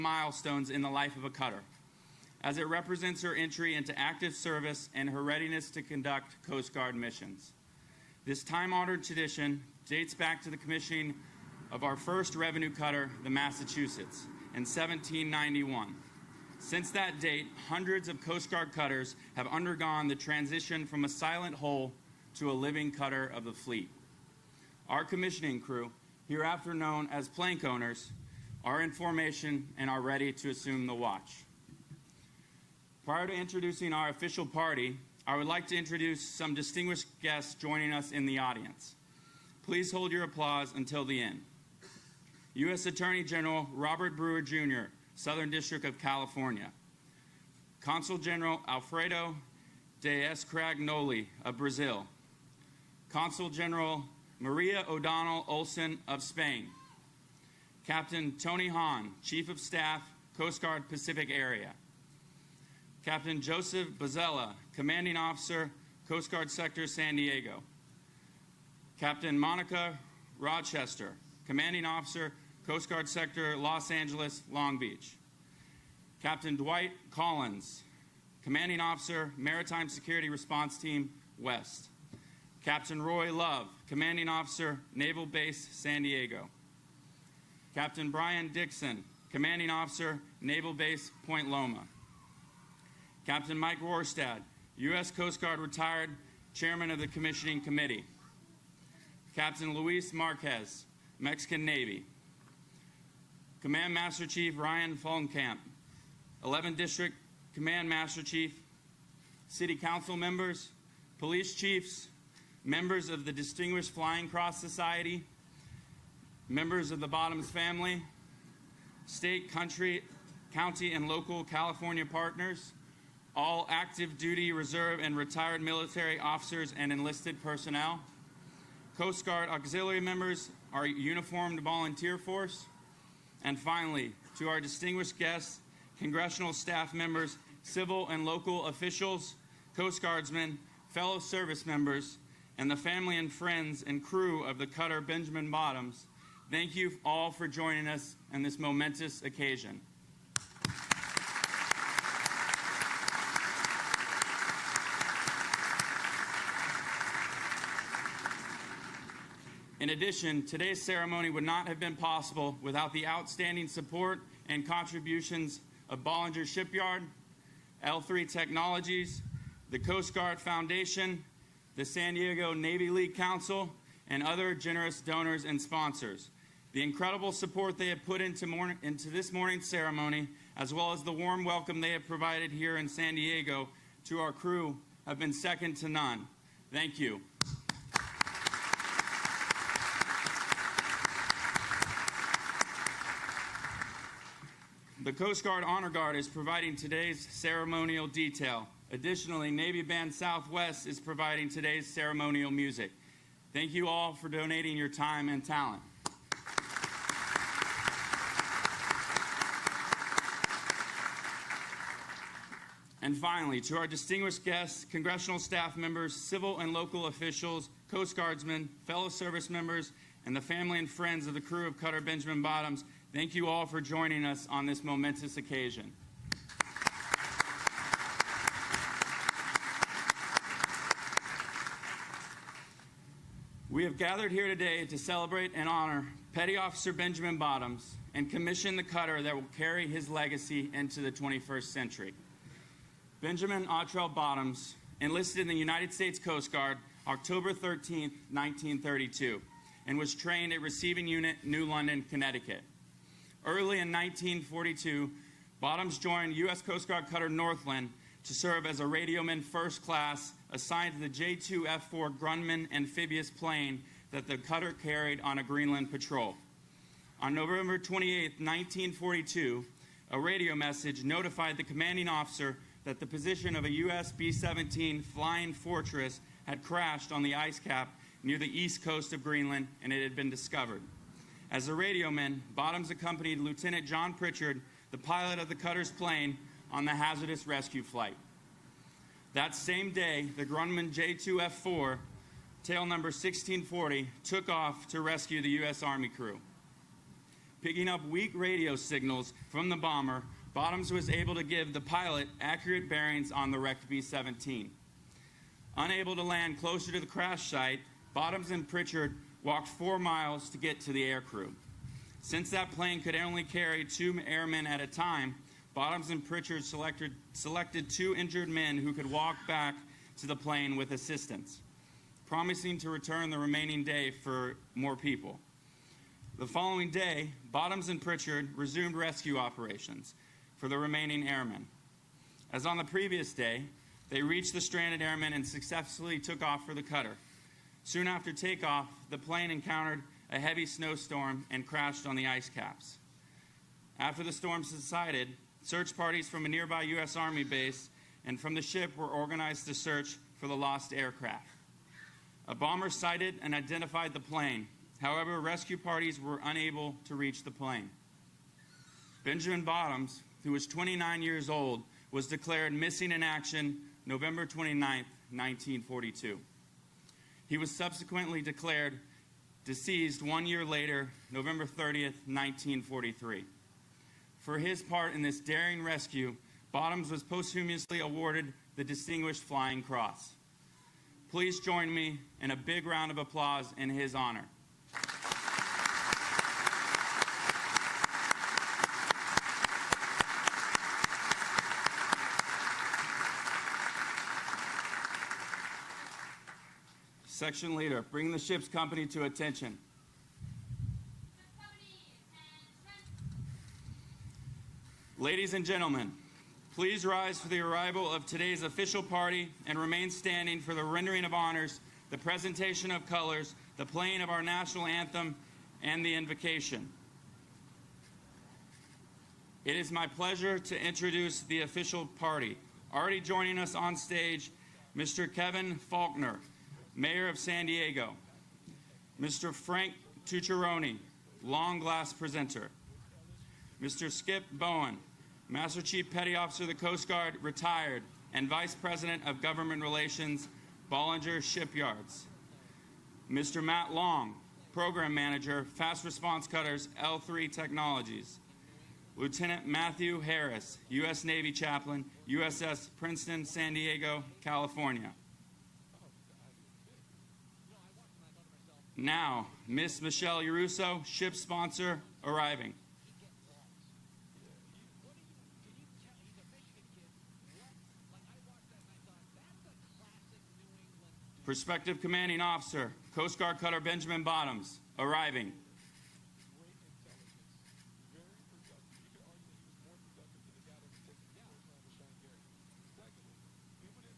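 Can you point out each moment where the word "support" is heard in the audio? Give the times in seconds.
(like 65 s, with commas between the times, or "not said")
163 s, 177 s.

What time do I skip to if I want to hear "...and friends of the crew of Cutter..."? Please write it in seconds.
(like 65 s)
220 s.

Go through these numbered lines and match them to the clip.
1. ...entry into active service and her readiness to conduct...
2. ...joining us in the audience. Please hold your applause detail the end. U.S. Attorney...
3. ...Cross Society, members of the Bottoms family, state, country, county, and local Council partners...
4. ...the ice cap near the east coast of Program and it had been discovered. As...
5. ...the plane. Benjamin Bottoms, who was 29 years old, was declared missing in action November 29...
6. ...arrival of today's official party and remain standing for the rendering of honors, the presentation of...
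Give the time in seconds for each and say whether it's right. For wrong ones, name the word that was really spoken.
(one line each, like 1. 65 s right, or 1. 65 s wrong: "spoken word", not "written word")
1. 3 s right
2. 37 s wrong: "until", not "detail"
3. 114 s wrong: "California", not "Council"
4. 277 s wrong: "Greenland", not "Program"
5. 357 s right
6. 407 s right.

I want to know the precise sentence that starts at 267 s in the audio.
On November 28, 1942, a radio message notified the commanding officer that the position of a U.S.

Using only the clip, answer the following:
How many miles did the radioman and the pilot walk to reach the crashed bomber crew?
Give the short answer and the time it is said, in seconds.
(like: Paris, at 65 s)
4, at 309 s.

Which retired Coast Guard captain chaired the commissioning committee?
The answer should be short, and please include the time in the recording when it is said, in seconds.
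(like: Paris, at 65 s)
Mike Rorstad, at 93 s.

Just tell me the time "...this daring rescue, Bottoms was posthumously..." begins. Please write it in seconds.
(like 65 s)
375 s.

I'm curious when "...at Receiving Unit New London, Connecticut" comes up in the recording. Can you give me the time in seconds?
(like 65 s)
250 s.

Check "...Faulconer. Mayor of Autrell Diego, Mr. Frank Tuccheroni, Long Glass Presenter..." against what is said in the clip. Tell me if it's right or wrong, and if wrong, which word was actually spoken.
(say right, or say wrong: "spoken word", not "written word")
wrong: "San", not "Autrell".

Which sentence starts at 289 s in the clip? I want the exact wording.
That same day, the Grumman J2F4, tail number 1640, took off to rescue the U.S.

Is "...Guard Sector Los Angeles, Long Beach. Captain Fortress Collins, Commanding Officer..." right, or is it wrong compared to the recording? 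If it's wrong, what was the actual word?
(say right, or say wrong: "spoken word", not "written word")
wrong: "Dwight", not "Fortress".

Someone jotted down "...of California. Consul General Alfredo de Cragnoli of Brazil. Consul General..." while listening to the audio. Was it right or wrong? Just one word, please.
right.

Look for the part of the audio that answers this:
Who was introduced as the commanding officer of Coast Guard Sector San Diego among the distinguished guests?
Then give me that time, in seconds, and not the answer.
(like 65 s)
63 s.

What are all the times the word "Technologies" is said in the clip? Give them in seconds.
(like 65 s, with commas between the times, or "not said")
168 s, 447 s.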